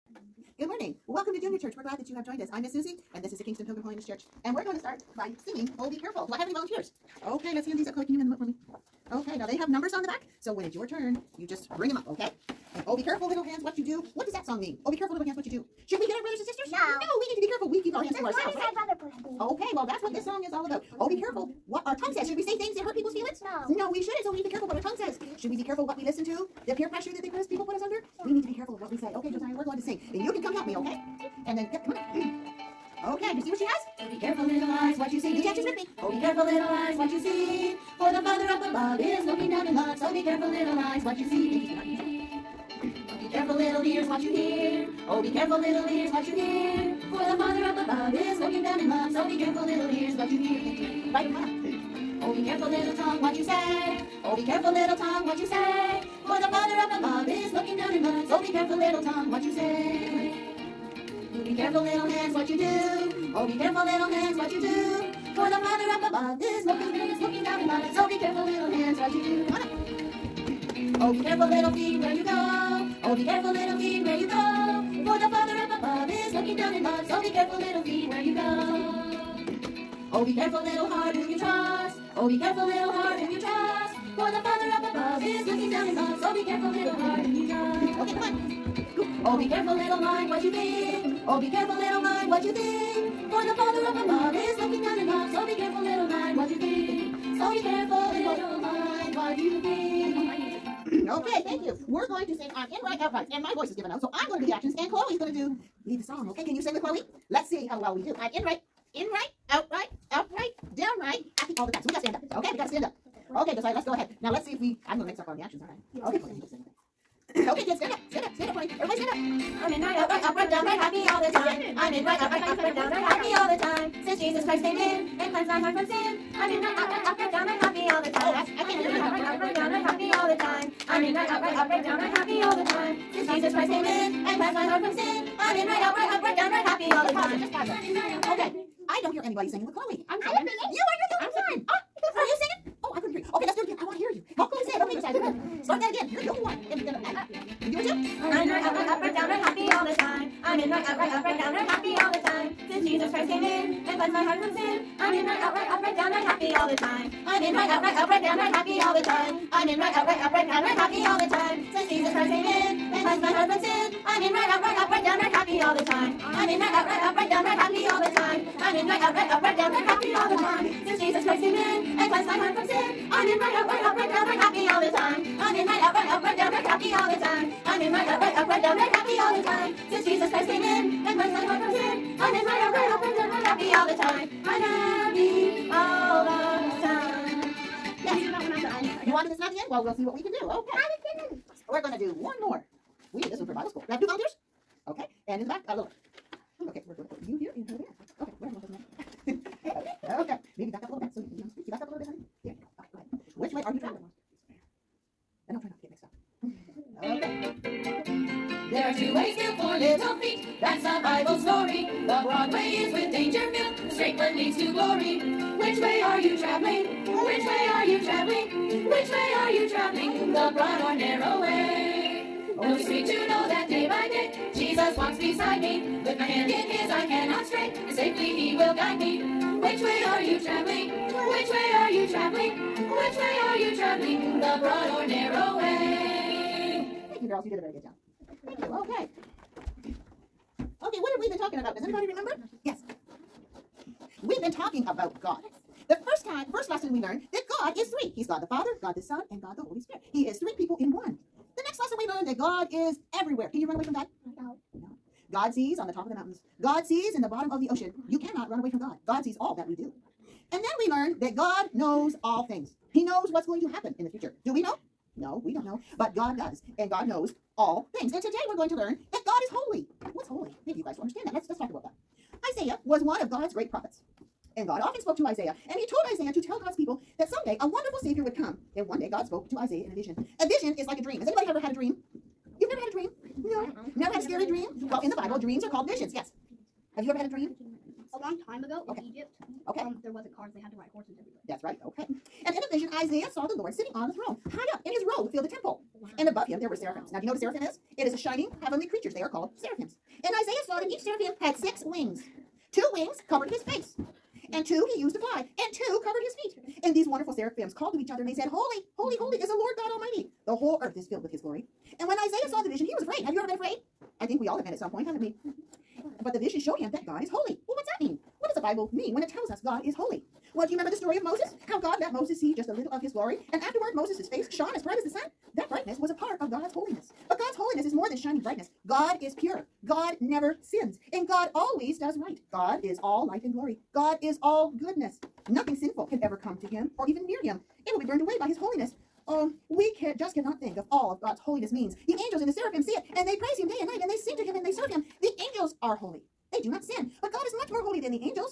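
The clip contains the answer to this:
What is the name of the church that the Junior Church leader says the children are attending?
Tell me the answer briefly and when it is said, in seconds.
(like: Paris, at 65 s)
Kingston Pilgrim Holiness Church, at 3 s.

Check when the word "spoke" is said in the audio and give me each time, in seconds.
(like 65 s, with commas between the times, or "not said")
275 s, 279 s.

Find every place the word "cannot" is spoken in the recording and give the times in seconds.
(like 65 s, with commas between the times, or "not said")
258 s, 340 s.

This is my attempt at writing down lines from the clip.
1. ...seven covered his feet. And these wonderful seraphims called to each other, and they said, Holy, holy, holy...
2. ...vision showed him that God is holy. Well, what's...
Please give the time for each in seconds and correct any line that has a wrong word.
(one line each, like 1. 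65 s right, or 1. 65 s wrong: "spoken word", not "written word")
1. 305 s wrong: "two", not "seven"
2. 316 s right.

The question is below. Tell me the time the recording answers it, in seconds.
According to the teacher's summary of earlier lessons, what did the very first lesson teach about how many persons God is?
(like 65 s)
247 s.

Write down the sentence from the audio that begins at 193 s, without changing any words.
We did this one for Bible school.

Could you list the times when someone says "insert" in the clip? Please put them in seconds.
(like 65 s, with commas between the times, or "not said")
not said.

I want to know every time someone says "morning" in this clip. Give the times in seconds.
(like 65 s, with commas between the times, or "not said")
0 s.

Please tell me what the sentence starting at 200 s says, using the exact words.
Maybe back up a little bit so you can be on the screen.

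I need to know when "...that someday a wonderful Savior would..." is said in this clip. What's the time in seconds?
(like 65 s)
277 s.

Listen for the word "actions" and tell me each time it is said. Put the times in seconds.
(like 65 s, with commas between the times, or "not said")
104 s, 115 s.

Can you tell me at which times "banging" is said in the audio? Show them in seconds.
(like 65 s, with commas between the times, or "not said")
not said.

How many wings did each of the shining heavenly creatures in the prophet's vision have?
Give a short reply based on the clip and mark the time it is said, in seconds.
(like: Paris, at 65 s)
6, at 301 s.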